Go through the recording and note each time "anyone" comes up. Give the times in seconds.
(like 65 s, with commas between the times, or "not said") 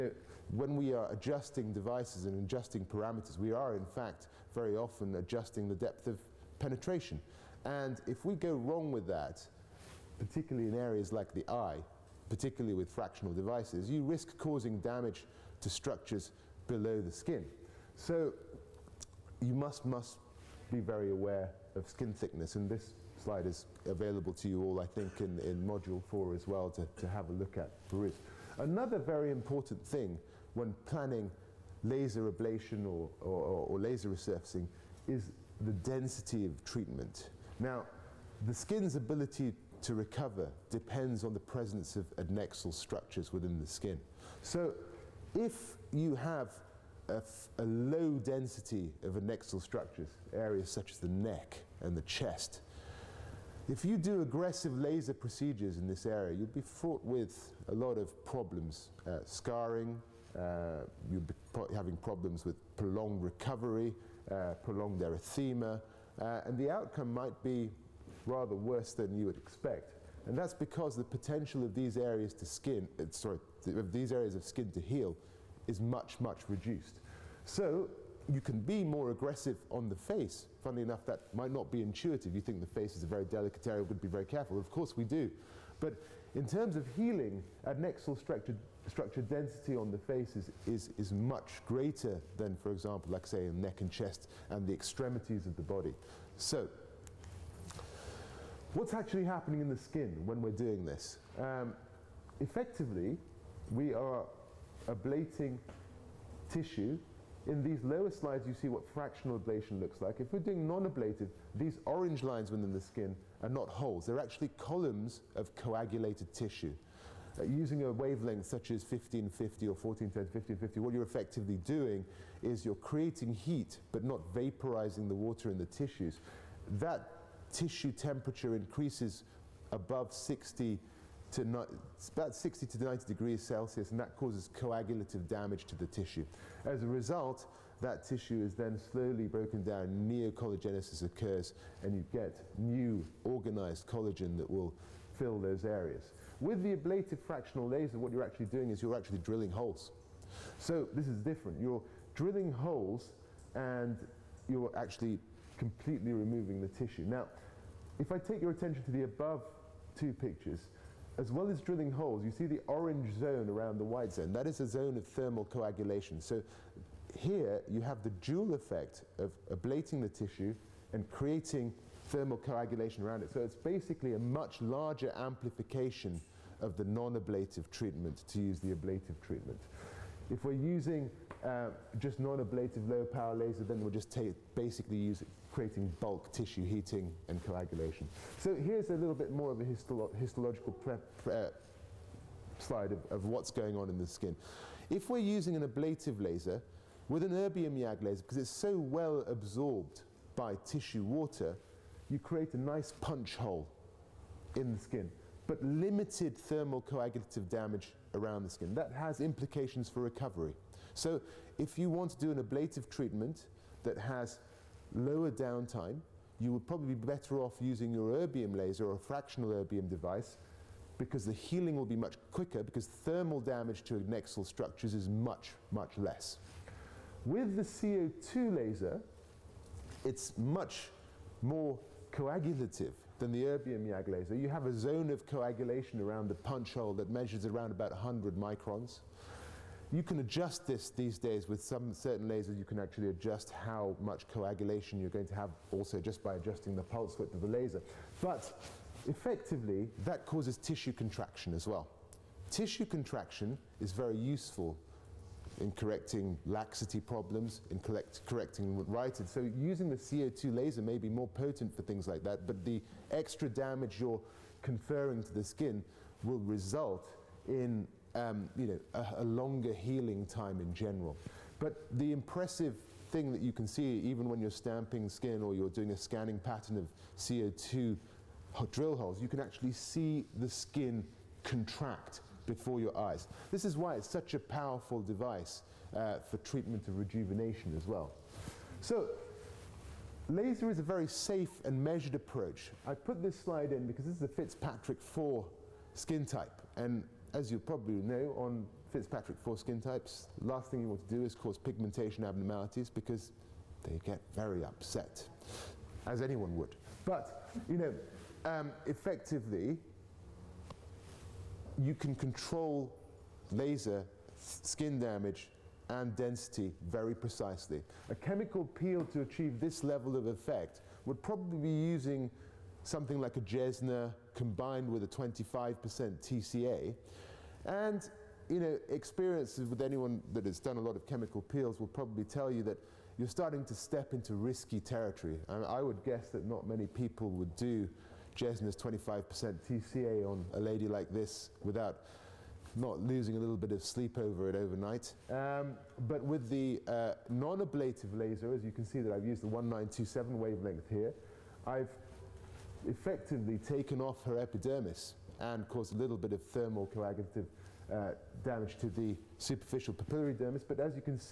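306 s, 329 s.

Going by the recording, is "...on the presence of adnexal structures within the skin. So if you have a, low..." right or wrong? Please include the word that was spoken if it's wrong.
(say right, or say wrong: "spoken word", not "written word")
right.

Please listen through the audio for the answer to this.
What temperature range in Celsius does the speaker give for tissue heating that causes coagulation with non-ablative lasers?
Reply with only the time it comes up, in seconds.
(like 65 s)
132 s.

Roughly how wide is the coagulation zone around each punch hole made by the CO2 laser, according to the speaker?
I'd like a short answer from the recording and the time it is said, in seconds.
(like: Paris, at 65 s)
100 microns, at 237 s.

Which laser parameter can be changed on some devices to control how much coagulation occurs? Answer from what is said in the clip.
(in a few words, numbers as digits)
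pulse width.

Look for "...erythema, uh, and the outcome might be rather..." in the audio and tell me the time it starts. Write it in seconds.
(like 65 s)
65 s.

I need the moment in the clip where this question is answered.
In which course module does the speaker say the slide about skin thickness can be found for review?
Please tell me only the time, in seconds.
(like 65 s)
25 s.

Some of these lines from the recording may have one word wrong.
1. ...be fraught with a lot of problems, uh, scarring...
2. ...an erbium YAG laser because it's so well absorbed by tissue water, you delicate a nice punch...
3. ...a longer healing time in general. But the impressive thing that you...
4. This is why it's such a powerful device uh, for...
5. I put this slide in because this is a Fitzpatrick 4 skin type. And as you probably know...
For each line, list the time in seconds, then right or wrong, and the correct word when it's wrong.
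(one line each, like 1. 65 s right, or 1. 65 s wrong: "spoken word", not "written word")
1. 56 s right
2. 197 s wrong: "create", not "delicate"
3. 269 s right
4. 283 s right
5. 292 s right.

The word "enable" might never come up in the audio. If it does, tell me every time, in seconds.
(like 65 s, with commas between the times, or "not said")
not said.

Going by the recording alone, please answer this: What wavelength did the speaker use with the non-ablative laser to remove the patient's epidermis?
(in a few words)
1927.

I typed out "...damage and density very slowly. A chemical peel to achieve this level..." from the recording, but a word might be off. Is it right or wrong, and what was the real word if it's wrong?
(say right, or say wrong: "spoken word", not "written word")
wrong: "precisely", not "slowly".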